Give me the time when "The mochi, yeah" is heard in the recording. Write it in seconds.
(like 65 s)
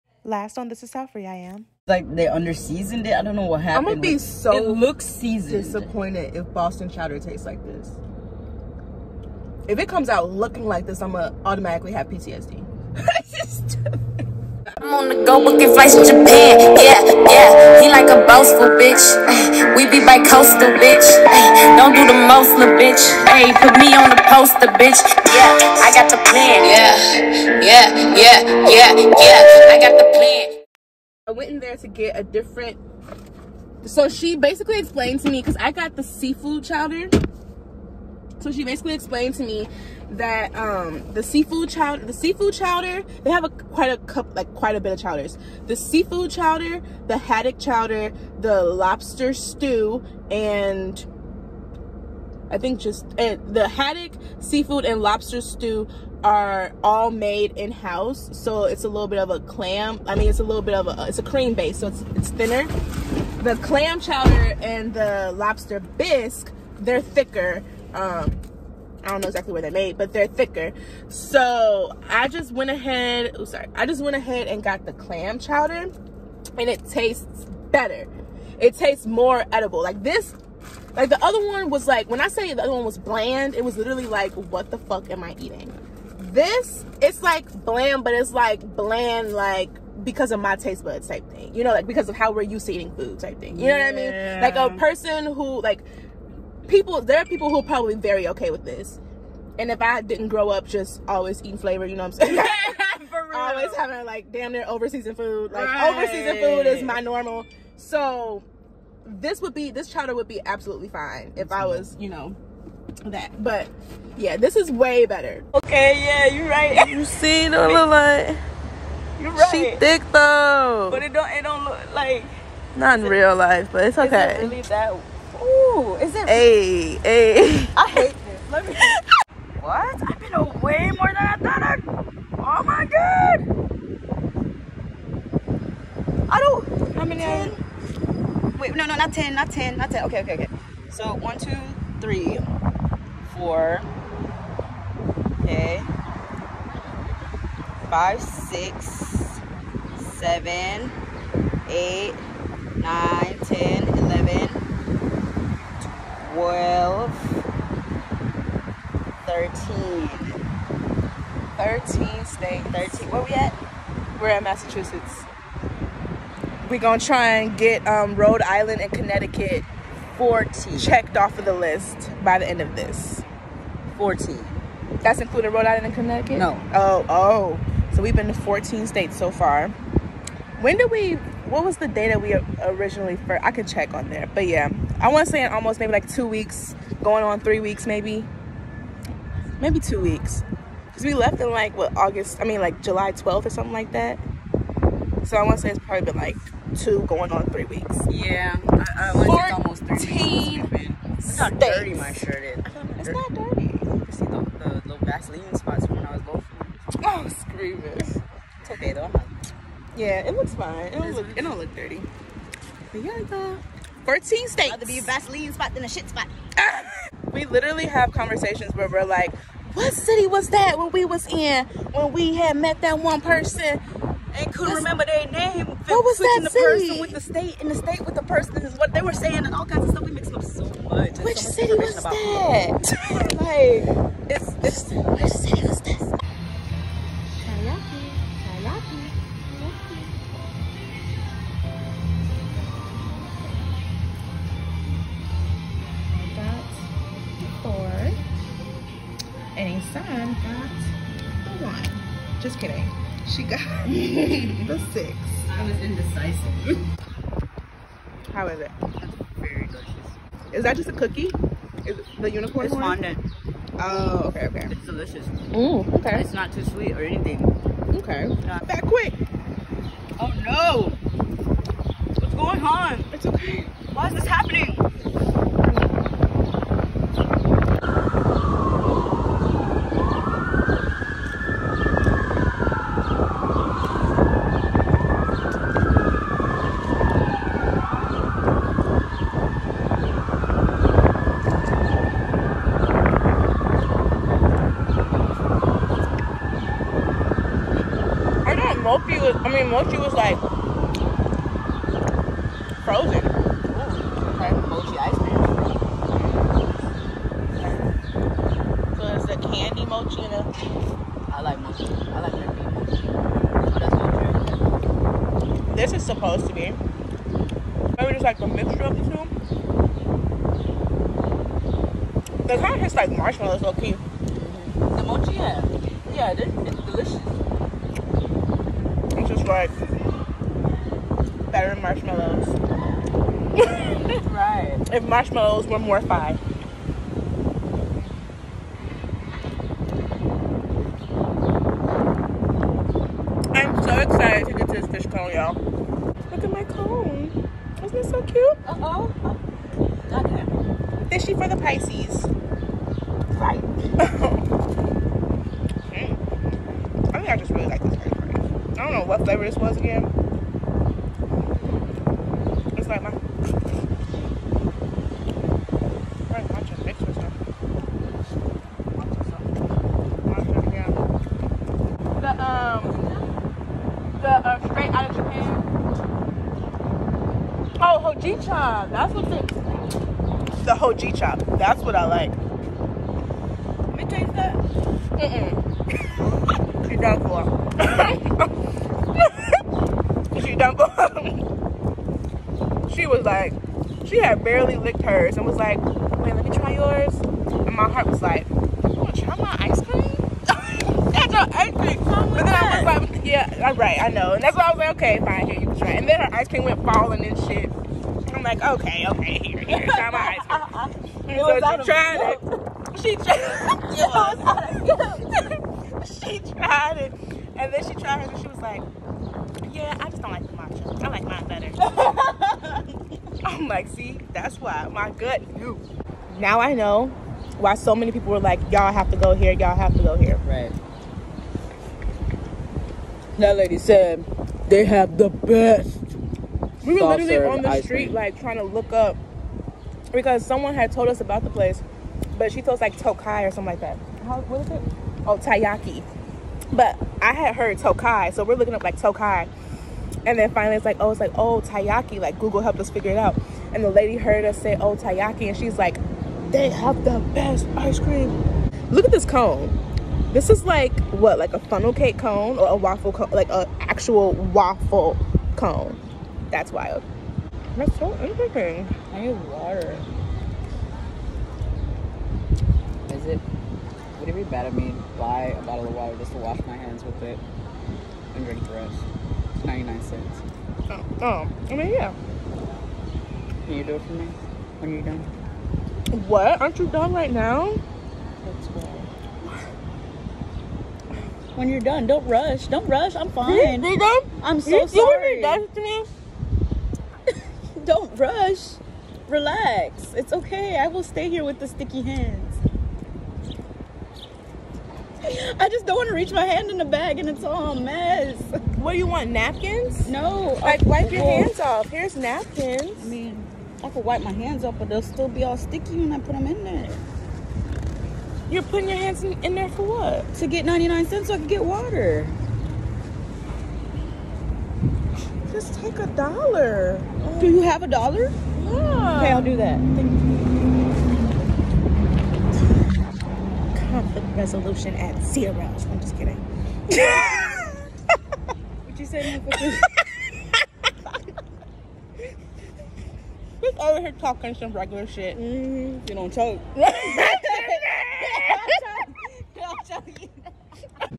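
324 s.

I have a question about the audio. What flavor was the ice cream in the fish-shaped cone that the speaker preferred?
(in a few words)
Hojicha.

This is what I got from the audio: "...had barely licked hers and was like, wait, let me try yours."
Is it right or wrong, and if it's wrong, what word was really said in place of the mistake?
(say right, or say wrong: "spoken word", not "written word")
right.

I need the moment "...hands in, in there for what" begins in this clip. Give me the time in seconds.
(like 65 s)
518 s.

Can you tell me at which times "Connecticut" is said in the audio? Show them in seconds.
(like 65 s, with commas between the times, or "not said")
168 s, 175 s.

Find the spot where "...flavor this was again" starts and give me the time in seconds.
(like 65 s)
359 s.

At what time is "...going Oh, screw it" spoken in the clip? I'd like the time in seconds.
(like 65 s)
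206 s.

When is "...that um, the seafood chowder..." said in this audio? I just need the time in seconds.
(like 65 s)
40 s.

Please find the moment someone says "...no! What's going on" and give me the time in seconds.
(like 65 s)
270 s.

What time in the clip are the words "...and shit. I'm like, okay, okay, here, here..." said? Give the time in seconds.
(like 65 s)
407 s.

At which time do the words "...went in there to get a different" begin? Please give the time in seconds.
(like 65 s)
31 s.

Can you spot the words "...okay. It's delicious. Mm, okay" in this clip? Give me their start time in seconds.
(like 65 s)
264 s.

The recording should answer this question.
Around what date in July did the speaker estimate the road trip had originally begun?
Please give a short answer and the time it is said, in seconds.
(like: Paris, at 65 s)
July 12, at 192 s.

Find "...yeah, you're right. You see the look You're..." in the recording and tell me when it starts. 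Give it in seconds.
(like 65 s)
116 s.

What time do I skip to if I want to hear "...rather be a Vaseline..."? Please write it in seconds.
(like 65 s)
214 s.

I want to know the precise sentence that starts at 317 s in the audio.
Maybe just like a mixture of the two.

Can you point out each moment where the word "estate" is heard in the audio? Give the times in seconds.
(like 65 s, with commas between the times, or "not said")
not said.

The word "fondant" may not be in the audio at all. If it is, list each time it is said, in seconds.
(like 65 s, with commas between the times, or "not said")
262 s.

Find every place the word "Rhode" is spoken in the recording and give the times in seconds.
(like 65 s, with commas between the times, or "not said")
168 s, 175 s.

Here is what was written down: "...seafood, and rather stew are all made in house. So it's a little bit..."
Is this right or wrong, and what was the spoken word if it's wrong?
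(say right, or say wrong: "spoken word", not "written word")
wrong: "lobster", not "rather".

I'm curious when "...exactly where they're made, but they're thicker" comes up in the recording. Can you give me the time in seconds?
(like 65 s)
69 s.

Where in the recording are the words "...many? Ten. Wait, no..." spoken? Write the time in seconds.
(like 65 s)
137 s.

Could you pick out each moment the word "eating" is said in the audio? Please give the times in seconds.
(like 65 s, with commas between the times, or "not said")
85 s, 92 s, 101 s.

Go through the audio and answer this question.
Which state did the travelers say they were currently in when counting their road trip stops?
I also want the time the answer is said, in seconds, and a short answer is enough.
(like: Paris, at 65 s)
Massachusetts, at 164 s.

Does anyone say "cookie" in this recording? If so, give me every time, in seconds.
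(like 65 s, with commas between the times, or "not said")
260 s.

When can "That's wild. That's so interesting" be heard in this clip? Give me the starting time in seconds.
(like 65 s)
466 s.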